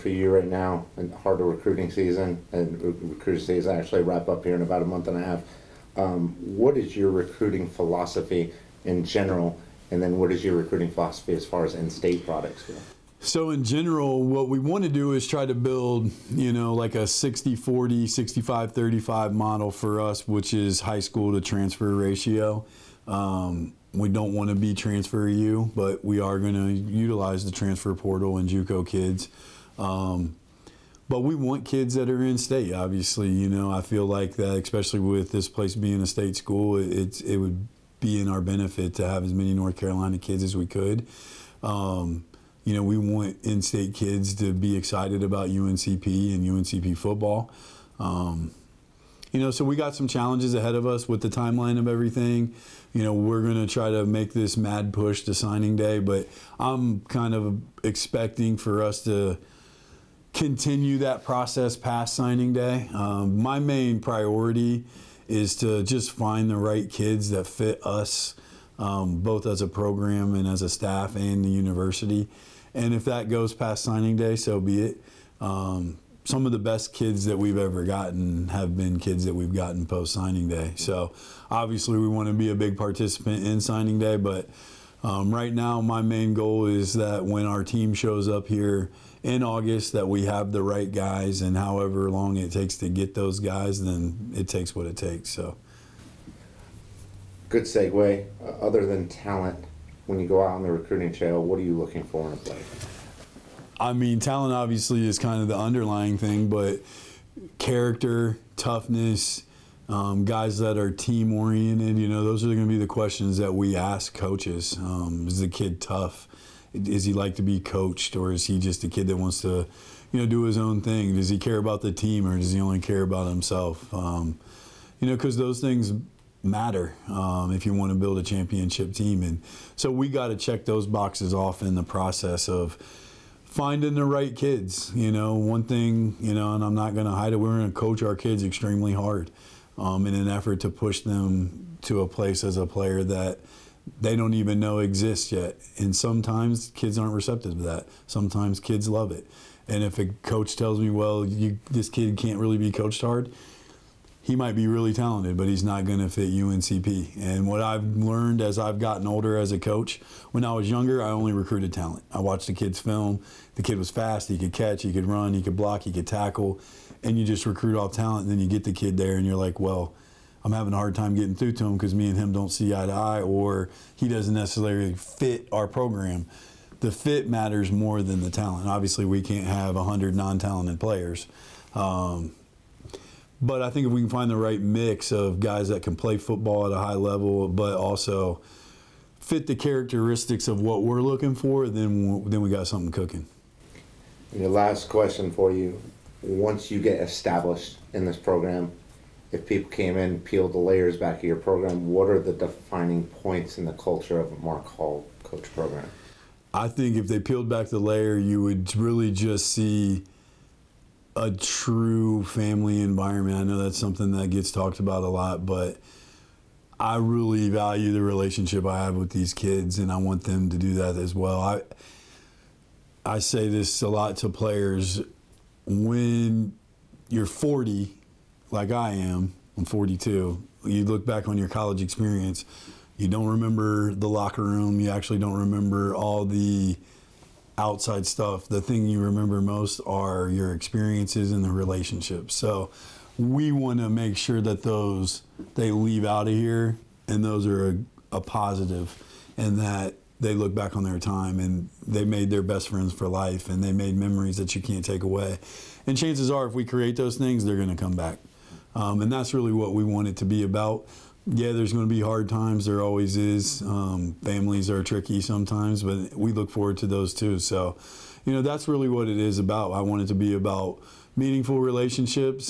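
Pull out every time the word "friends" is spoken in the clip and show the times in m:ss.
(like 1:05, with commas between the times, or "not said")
4:12.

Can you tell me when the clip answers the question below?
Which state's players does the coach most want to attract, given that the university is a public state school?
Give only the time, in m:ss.
0:39.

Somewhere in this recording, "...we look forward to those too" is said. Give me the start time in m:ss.
4:26.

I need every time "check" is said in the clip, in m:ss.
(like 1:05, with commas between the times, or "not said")
2:10.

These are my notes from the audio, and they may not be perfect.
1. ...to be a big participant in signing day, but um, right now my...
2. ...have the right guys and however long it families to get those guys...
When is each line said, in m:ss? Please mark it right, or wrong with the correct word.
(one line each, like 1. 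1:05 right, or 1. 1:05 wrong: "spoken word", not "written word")
1. 1:22 right
2. 1:30 wrong: "takes", not "families".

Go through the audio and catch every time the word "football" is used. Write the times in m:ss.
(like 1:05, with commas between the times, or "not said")
0:46, 3:06.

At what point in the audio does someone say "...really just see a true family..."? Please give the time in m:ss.
3:28.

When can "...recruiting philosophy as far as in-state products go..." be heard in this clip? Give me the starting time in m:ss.
0:10.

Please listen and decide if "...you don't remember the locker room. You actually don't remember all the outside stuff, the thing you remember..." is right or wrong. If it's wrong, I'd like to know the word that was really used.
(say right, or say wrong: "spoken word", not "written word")
right.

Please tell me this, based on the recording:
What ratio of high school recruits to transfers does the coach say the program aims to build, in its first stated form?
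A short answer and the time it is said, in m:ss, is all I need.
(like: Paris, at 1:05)
60/40, at 0:17.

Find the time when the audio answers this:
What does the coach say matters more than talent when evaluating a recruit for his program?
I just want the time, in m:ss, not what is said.
2:56.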